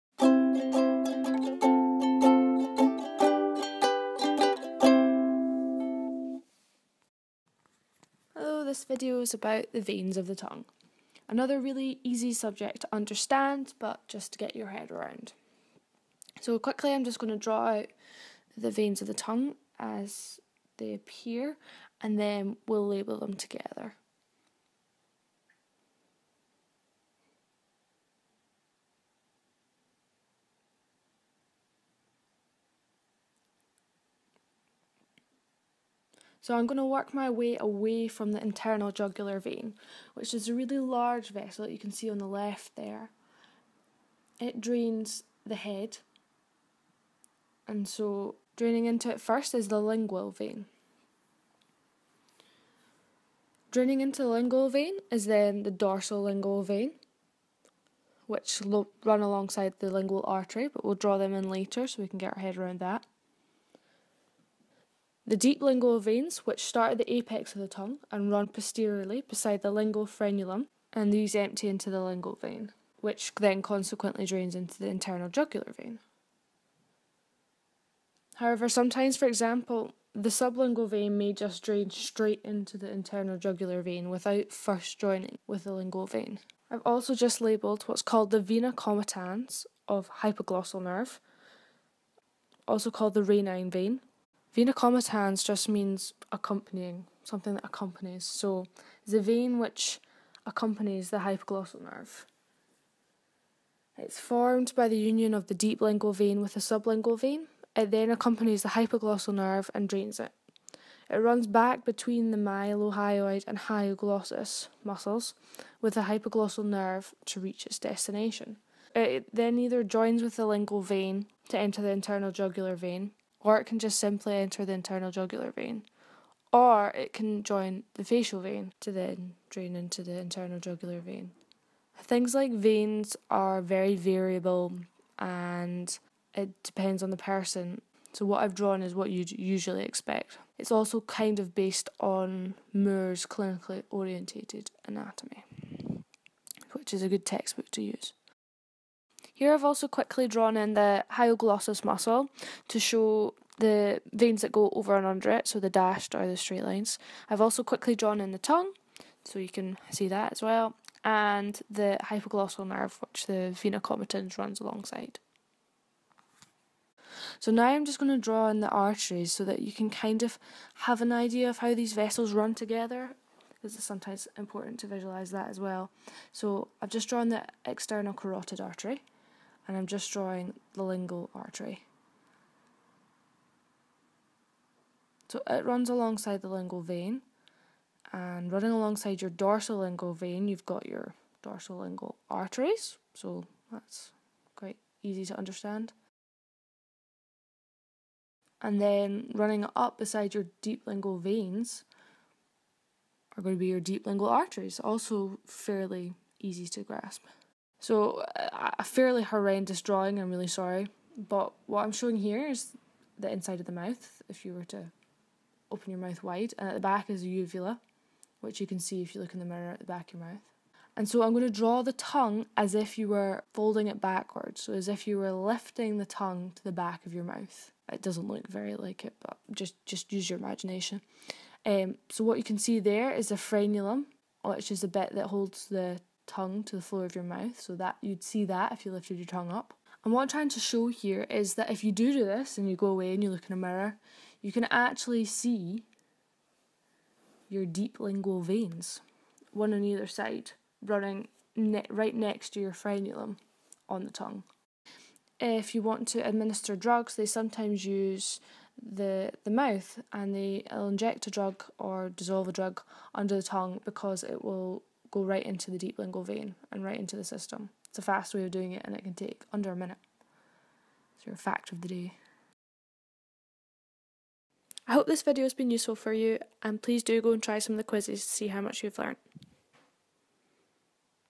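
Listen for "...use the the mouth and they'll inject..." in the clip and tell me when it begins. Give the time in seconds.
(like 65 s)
257 s.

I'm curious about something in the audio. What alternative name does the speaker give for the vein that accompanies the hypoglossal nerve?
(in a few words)
Ranine vein.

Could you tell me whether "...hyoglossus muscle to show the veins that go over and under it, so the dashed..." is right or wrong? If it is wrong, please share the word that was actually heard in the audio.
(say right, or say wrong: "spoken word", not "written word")
right.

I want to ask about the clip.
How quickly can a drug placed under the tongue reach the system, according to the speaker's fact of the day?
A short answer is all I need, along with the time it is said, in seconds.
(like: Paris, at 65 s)
Under a minute, at 269 s.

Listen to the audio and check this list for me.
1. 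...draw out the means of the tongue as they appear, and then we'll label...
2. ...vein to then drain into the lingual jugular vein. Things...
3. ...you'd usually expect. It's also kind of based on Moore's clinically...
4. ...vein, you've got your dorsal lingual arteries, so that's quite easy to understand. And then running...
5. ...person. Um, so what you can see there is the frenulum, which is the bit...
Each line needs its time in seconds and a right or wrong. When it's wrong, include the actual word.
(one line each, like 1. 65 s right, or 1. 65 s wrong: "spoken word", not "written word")
1. 17 s wrong: "veins", not "means"
2. 128 s wrong: "internal", not "lingual"
3. 139 s right
4. 190 s right
5. 230 s wrong: "imagination", not "person".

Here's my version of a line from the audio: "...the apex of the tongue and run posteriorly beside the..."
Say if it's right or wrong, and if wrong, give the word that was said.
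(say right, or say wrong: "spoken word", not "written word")
right.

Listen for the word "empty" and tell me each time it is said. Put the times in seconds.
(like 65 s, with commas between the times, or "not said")
71 s.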